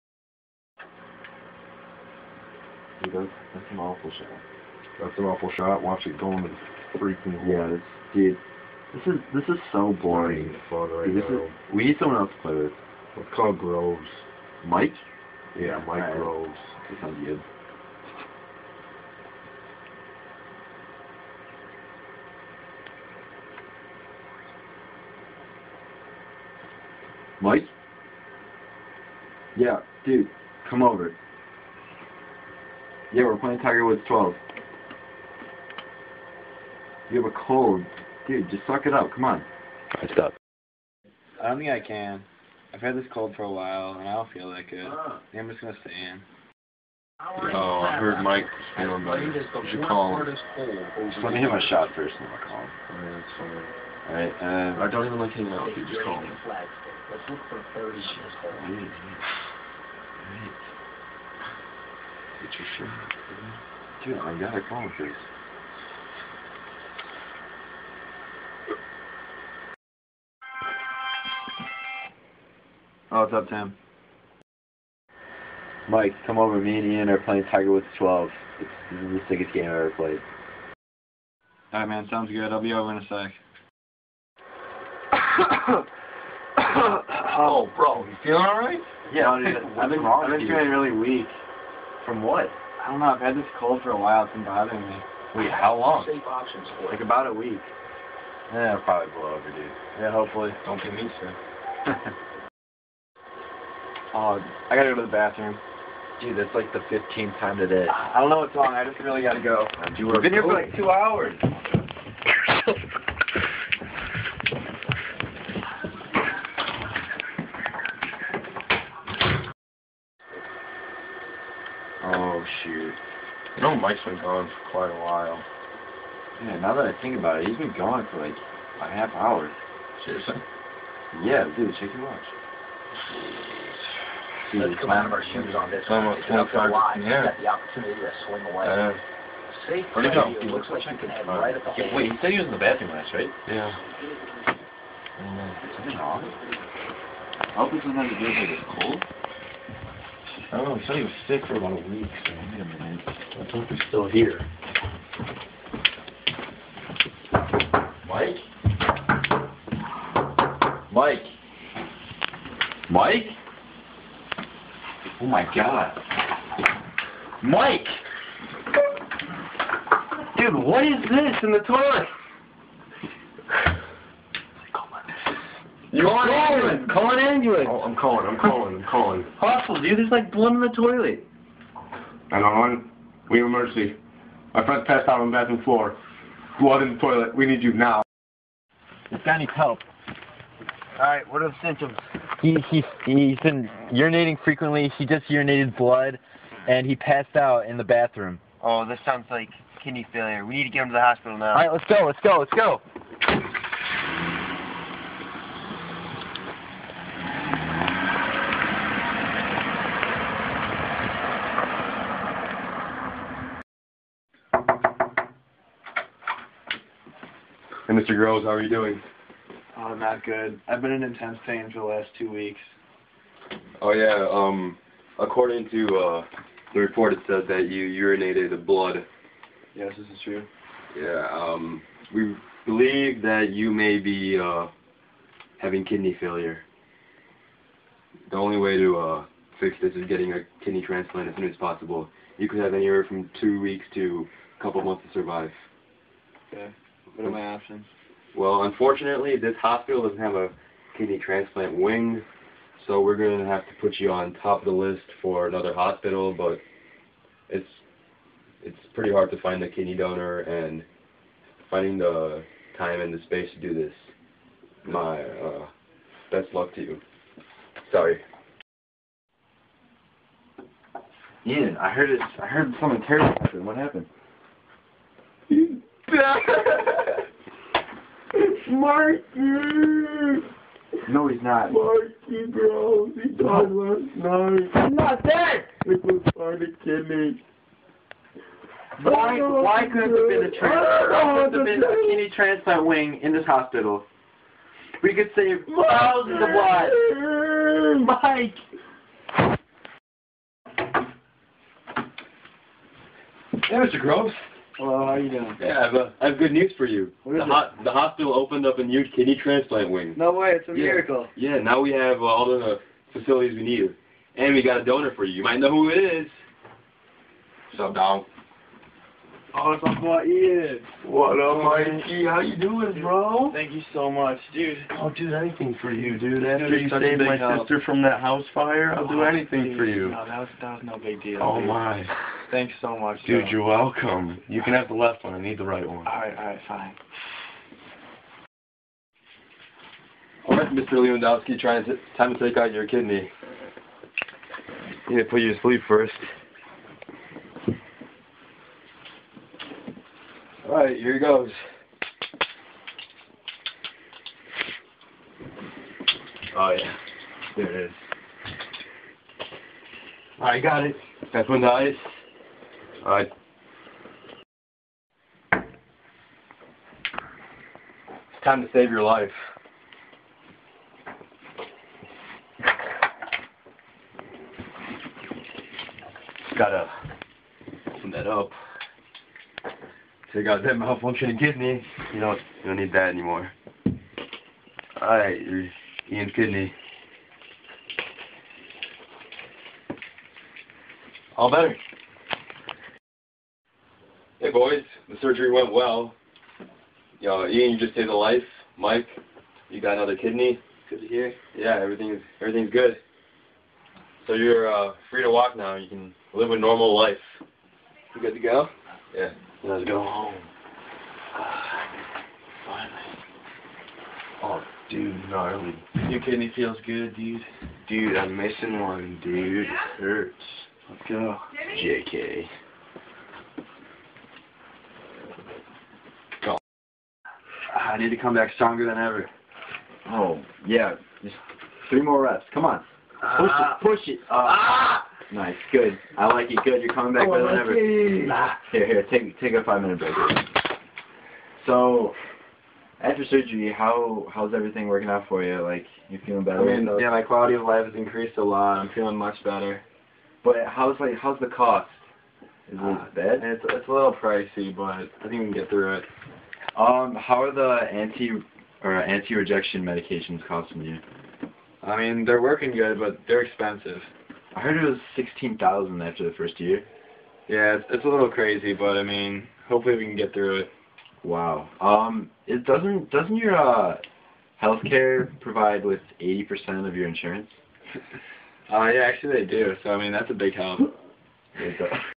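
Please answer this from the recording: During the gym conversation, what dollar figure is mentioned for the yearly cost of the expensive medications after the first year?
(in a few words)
$16,000.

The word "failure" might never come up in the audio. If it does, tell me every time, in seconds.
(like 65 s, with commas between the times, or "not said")
200 s, 236 s.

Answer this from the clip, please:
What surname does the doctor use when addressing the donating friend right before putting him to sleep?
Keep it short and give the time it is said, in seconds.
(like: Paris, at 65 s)
Lewandoski, at 340 s.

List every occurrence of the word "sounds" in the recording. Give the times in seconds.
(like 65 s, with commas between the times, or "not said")
17 s, 82 s, 199 s.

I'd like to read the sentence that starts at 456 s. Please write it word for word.
Um, how are the anti or anti-rejection medications costing you?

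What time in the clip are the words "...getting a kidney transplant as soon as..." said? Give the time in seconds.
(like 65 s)
240 s.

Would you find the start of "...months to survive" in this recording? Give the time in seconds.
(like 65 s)
244 s.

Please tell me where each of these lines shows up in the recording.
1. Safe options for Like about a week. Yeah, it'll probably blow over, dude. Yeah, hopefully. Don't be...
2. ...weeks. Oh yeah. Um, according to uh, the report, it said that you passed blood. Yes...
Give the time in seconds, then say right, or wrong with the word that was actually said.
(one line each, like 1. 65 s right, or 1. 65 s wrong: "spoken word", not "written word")
1. 96 s right
2. 222 s wrong: "urinated", not "passed".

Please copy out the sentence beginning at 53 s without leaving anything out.
Oh, Alright, um, uh, I don't even like hanging out with you.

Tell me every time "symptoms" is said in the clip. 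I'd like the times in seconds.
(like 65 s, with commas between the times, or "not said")
191 s.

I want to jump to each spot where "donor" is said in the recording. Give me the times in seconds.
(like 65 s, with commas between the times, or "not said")
259 s, 314 s.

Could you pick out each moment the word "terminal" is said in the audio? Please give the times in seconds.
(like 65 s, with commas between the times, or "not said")
not said.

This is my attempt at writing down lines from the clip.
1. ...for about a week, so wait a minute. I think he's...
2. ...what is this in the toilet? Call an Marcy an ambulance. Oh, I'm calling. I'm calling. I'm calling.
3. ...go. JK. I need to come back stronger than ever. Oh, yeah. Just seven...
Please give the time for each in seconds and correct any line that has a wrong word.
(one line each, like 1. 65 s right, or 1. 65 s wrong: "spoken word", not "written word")
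1. 151 s right
2. 170 s wrong: "Call", not "Marcy"
3. 421 s wrong: "three", not "seven".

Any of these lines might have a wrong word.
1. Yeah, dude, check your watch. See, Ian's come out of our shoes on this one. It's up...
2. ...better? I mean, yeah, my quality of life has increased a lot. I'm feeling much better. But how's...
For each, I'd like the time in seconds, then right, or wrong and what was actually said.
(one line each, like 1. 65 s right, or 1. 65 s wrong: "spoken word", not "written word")
1. 131 s wrong: "Let", not "Ian"
2. 446 s right.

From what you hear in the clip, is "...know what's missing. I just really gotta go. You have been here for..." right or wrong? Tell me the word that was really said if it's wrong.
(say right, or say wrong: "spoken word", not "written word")
wrong: "wrong", not "missing".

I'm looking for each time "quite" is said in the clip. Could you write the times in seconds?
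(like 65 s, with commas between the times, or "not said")
124 s.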